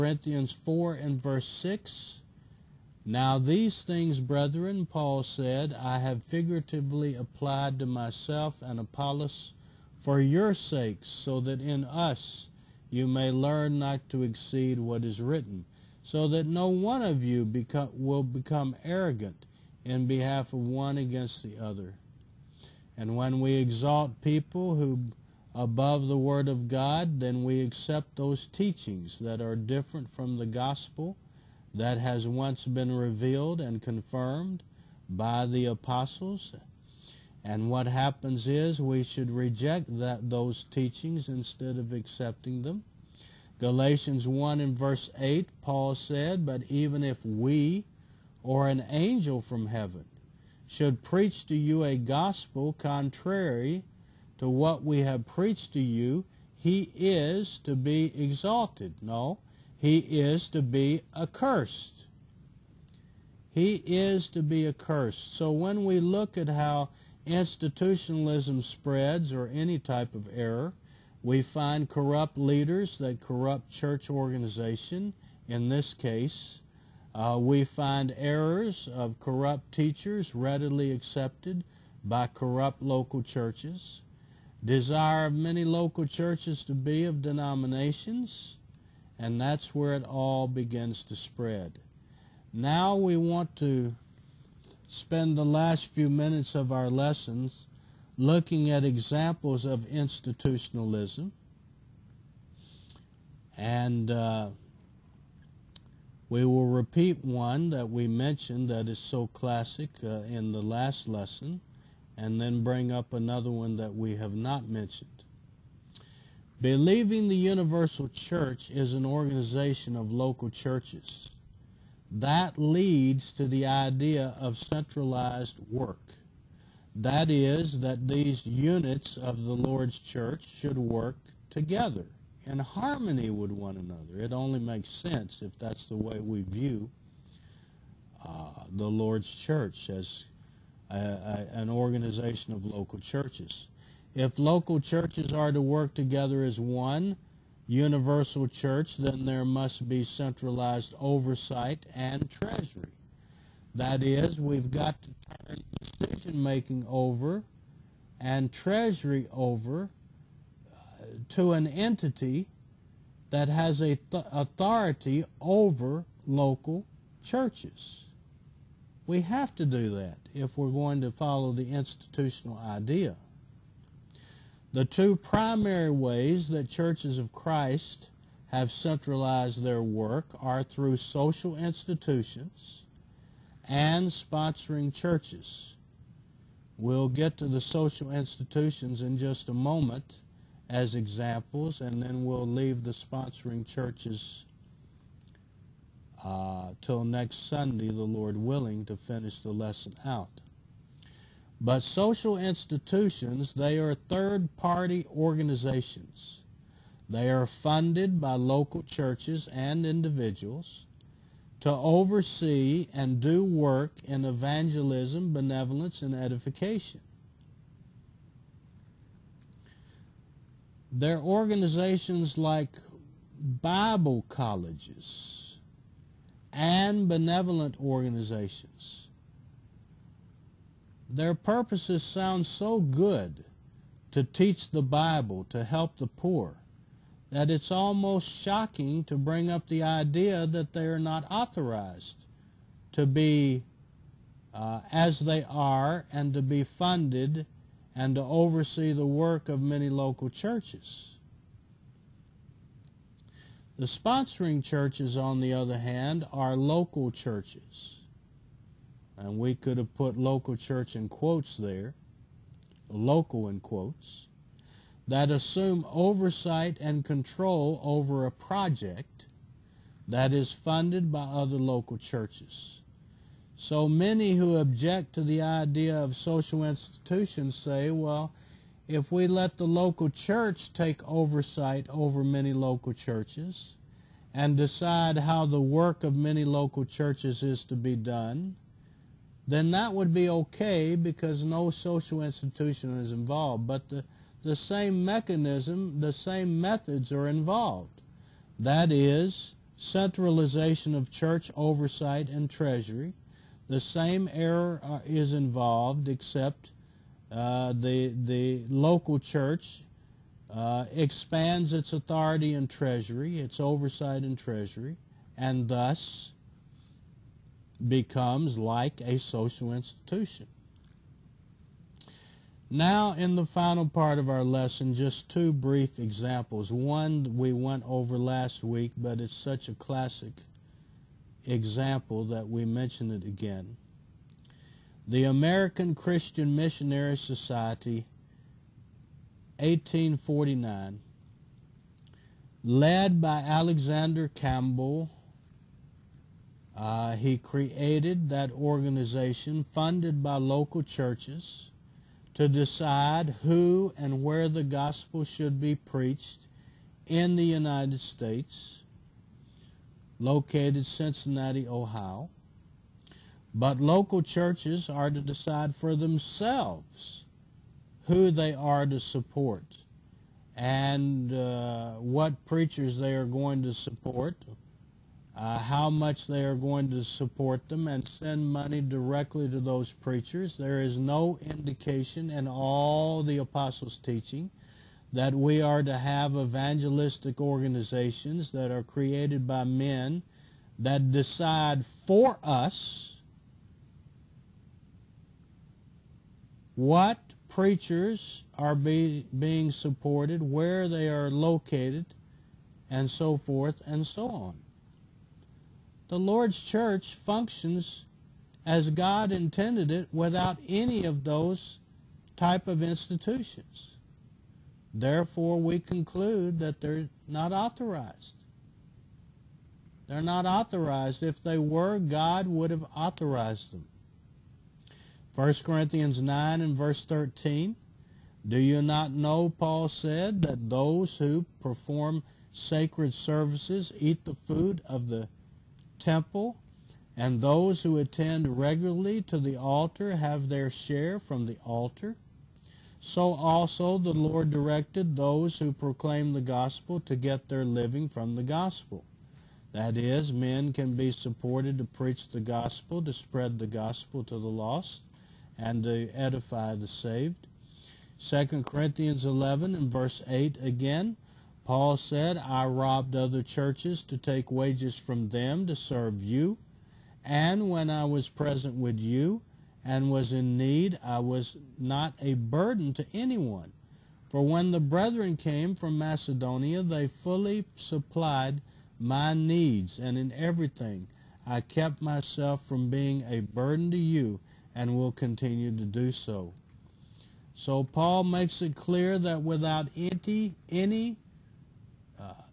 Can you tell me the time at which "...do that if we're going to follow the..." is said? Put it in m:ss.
2:49.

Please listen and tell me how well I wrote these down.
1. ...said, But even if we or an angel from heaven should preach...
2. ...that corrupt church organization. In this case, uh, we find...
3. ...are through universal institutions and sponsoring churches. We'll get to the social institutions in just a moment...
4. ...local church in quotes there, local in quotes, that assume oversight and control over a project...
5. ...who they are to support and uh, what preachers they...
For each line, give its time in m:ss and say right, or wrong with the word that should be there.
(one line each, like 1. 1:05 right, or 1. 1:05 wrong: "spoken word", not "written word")
1. 0:45 right
2. 1:12 right
3. 3:00 wrong: "social", not "universal"
4. 4:20 right
5. 6:08 right.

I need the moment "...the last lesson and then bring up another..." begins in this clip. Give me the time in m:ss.
1:50.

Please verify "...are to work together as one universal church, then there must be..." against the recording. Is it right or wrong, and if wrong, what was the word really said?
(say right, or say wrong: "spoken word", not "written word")
right.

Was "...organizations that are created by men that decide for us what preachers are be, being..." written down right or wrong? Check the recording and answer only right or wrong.
right.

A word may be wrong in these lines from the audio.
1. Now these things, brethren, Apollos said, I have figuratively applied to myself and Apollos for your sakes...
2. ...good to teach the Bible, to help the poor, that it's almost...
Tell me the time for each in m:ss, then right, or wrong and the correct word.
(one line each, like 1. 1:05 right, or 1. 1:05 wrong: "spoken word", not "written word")
1. 0:03 wrong: "Paul", not "Apollos"
2. 3:52 right.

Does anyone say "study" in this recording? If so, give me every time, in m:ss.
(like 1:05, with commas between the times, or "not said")
not said.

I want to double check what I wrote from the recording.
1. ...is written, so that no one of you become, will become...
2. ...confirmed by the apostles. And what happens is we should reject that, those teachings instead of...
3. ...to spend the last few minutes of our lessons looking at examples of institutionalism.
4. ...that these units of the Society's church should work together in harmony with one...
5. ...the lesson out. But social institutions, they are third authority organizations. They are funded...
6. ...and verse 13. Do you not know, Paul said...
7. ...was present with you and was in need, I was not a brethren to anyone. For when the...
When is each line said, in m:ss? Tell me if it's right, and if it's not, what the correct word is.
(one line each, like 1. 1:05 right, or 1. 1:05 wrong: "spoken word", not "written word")
1. 0:15 right
2. 0:33 right
3. 1:33 right
4. 2:07 wrong: "Lord", not "Society"
5. 3:19 wrong: "party", not "authority"
6. 7:06 right
7. 7:48 wrong: "burden", not "brethren".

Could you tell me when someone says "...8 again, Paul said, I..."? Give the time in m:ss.
7:40.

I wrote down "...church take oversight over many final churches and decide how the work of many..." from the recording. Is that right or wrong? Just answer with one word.
wrong.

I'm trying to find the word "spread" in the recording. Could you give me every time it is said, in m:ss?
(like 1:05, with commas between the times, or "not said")
1:08, 1:31, 7:33.